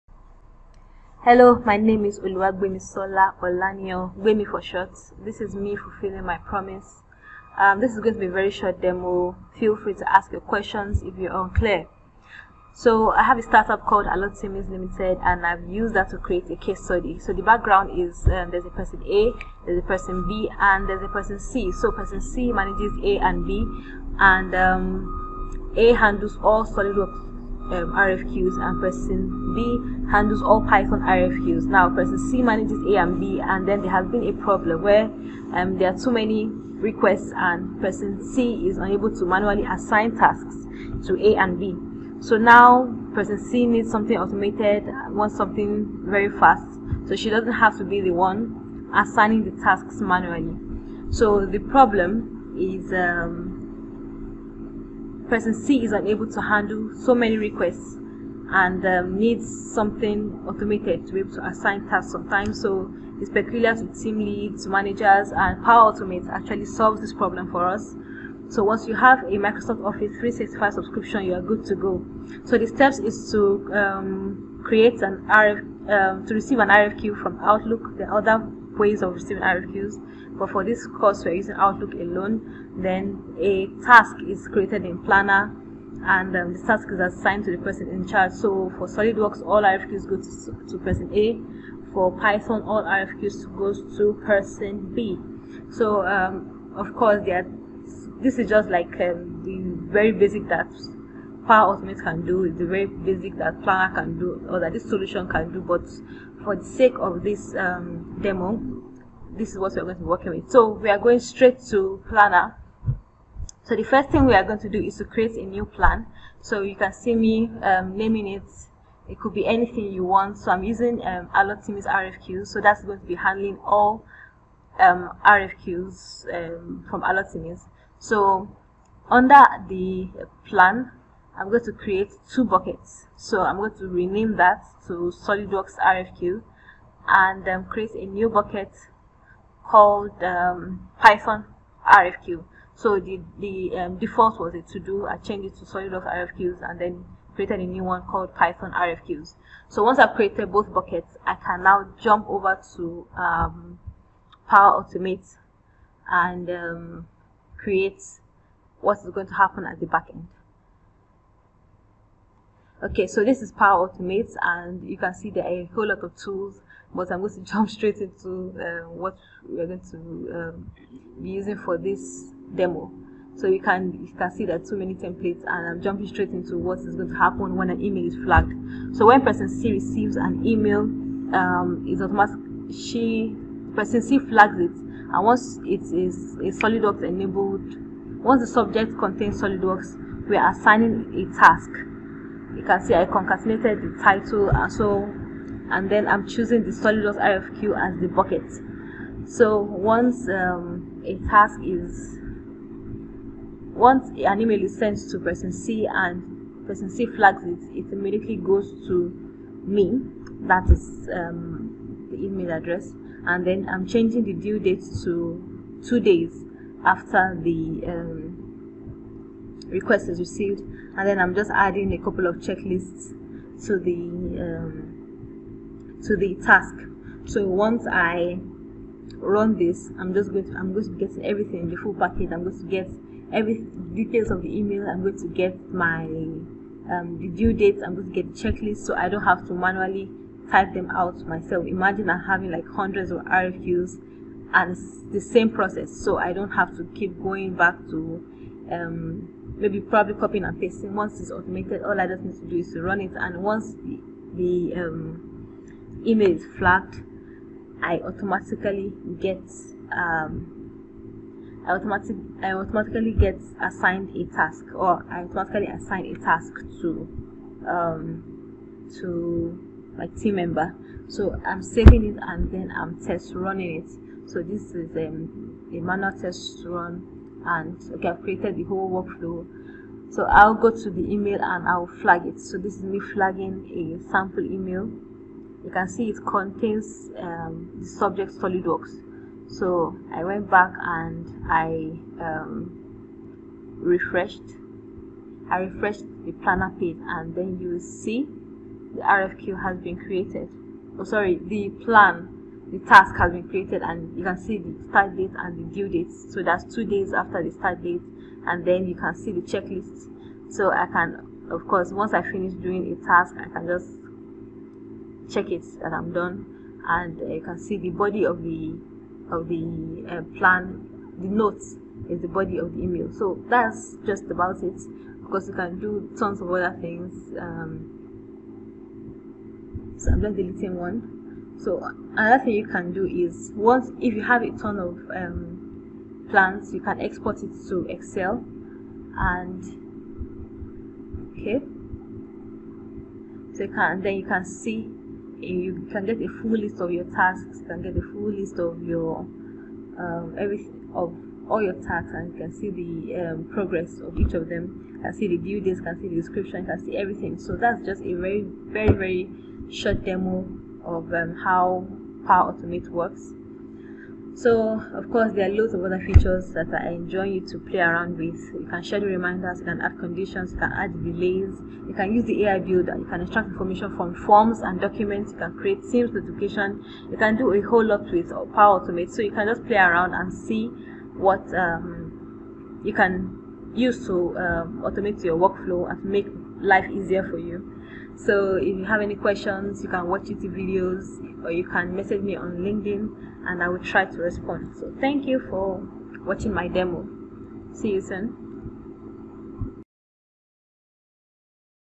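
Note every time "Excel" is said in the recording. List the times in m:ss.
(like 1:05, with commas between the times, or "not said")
5:37.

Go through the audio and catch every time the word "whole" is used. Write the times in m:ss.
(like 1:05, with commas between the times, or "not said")
2:45, 4:38, 6:17.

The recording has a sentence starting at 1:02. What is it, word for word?
So it's peculiar to team leads, managers, and Power Automate actually solves this problem for us.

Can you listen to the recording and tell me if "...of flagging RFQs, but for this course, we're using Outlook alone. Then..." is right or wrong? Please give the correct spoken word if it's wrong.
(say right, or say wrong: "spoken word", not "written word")
wrong: "receiving", not "flagging".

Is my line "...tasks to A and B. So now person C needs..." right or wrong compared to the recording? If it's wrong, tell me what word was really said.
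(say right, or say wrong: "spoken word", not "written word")
right.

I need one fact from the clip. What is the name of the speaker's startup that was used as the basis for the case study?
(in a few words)
Alotimis Limited.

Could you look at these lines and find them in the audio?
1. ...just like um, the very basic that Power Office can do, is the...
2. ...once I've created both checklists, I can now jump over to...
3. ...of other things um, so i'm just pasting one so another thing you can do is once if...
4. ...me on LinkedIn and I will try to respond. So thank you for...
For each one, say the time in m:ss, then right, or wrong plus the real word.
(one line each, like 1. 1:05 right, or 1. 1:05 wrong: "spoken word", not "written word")
1. 1:38 wrong: "Automate", not "Office"
2. 2:29 wrong: "buckets", not "checklists"
3. 5:26 wrong: "deleting", not "pasting"
4. 6:32 right.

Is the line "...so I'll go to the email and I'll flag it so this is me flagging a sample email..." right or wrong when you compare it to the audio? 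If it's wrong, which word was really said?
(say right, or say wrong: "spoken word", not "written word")
right.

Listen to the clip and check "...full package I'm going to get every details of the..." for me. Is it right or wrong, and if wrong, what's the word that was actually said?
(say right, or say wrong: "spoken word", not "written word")
right.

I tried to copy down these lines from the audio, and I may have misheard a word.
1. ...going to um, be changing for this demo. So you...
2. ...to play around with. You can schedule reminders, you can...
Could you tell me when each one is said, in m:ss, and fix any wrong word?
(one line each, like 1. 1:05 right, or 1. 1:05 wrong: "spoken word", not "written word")
1. 2:49 wrong: "using", not "changing"
2. 6:07 right.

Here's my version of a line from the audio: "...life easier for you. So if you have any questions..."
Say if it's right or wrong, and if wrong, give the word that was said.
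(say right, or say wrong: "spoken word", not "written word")
right.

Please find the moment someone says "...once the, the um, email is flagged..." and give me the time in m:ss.
4:13.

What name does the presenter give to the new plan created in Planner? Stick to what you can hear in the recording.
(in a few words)
Allotimis RFQ.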